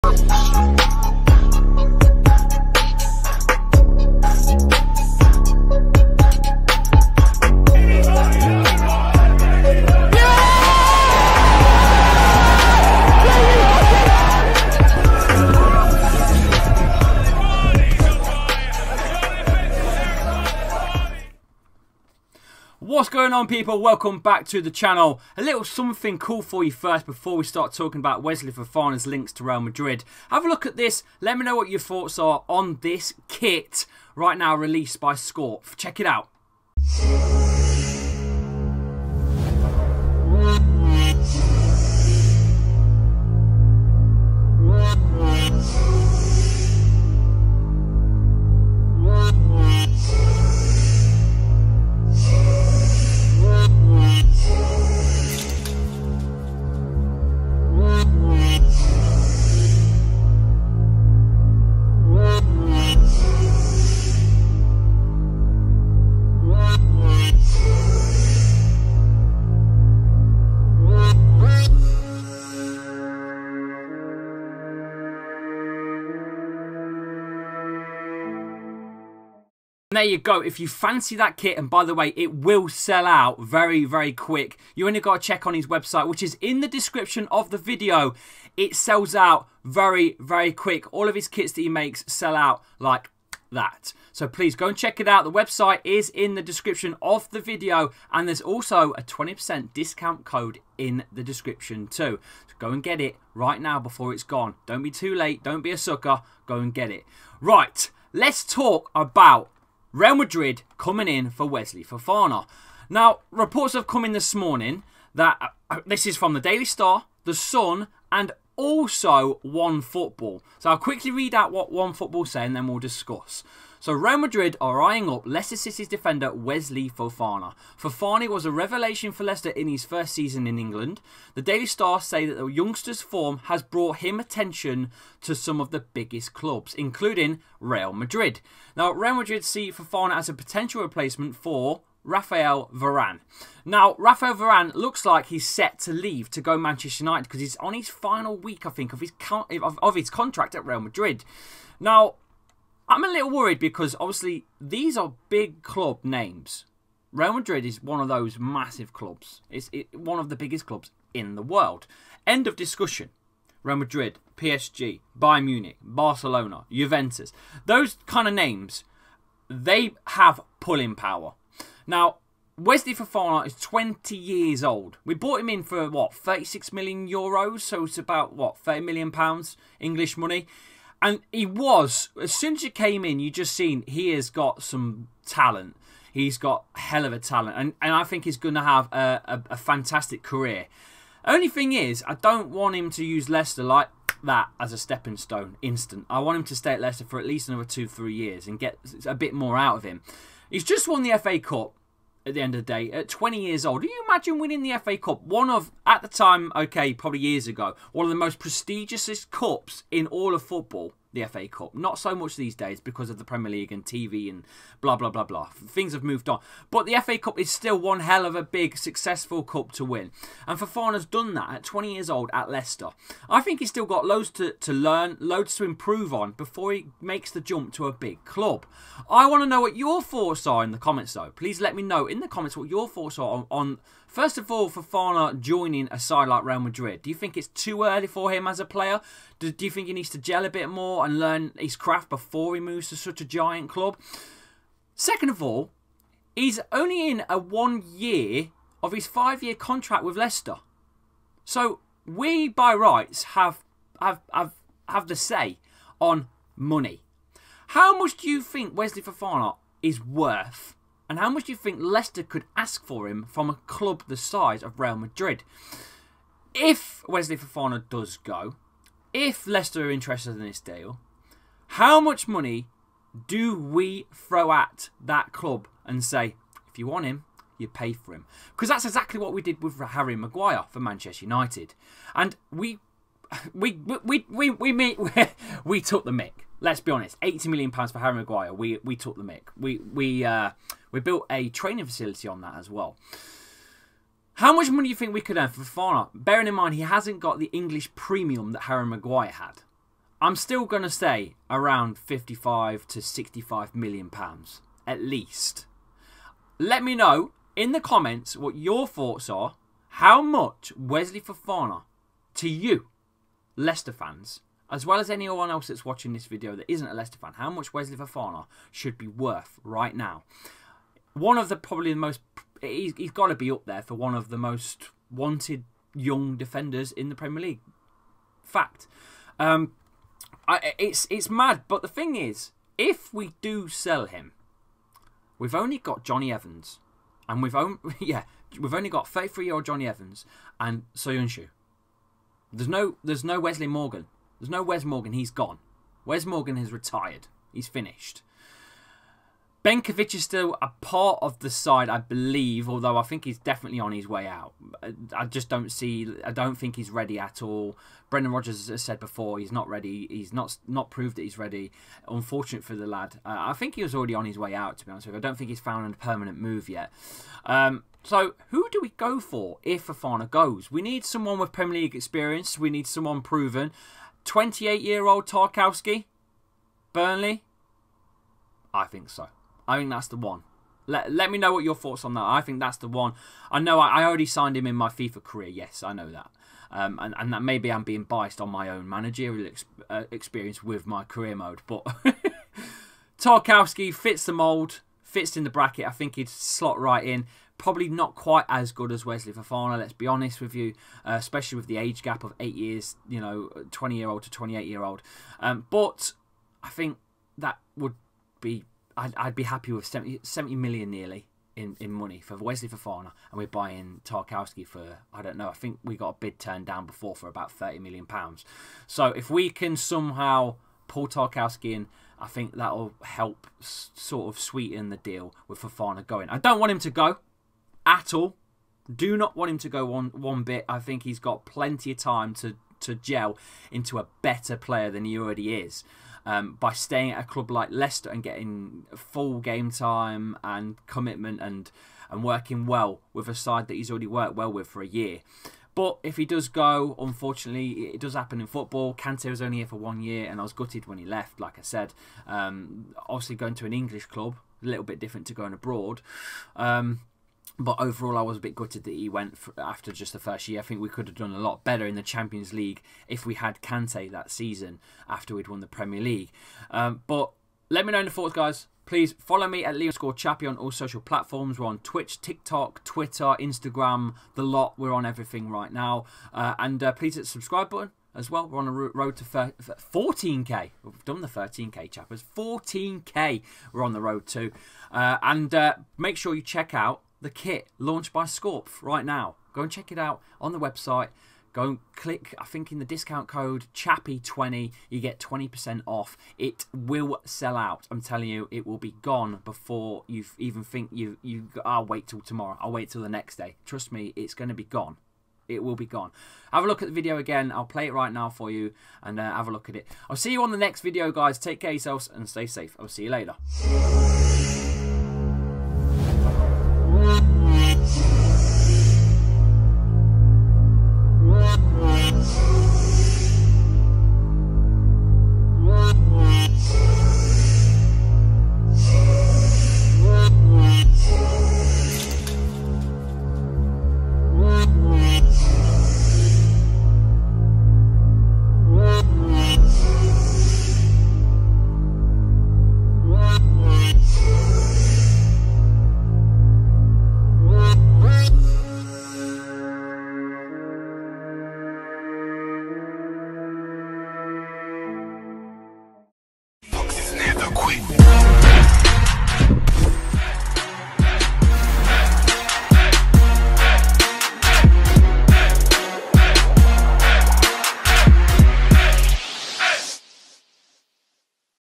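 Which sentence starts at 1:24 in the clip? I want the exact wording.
You only got to check on his website, which is in the description of the video.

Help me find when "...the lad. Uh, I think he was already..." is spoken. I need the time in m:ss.
6:02.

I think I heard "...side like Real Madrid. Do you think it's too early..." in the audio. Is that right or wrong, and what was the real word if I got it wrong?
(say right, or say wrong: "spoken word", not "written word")
right.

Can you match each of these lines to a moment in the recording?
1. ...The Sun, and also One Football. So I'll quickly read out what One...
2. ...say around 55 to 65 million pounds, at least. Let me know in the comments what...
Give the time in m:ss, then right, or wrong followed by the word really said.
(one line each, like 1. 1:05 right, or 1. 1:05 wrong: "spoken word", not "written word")
1. 1:57 right
2. 5:00 right.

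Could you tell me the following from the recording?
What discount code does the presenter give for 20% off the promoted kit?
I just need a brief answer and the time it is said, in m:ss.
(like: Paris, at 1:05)
Chappy20, at 8:13.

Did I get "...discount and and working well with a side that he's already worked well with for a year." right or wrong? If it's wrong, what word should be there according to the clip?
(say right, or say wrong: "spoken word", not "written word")
wrong: "commitment", not "discount".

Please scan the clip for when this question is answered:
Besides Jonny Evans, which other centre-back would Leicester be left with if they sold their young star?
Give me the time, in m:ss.
5:40.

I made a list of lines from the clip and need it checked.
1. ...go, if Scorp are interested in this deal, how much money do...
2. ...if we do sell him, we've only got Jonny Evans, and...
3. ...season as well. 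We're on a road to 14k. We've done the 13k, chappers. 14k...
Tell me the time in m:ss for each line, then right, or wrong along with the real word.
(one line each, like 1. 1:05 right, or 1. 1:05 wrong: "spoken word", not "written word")
1. 4:28 wrong: "Leicester", not "Scorp"
2. 5:32 right
3. 7:57 wrong: "button", not "season".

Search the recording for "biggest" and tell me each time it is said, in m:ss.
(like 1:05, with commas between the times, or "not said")
2:15, 2:40.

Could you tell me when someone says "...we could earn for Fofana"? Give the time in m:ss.
4:55.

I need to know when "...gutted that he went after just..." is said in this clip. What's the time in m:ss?
7:38.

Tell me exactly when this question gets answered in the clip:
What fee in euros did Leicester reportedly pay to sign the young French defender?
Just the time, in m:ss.
2:56.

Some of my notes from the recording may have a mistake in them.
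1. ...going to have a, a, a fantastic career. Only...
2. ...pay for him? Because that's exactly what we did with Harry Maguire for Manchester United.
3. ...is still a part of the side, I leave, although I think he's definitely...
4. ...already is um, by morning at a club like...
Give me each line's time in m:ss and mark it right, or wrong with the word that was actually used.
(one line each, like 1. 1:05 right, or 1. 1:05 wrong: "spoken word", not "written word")
1. 3:08 right
2. 4:37 right
3. 5:50 wrong: "believe", not "leave"
4. 7:15 wrong: "staying", not "morning".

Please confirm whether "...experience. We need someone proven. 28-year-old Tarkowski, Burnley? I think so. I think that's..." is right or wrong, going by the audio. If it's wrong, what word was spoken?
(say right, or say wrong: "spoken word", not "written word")
right.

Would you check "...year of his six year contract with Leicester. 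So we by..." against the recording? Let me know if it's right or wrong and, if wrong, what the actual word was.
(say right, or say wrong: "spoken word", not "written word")
wrong: "five", not "six".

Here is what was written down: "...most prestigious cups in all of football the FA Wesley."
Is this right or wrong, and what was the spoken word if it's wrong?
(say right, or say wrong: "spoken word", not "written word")
wrong: "Cup", not "Wesley".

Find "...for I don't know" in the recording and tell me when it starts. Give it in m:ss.
6:54.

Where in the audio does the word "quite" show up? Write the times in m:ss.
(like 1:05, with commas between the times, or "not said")
6:38.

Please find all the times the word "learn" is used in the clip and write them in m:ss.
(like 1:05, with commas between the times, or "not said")
3:44, 4:01.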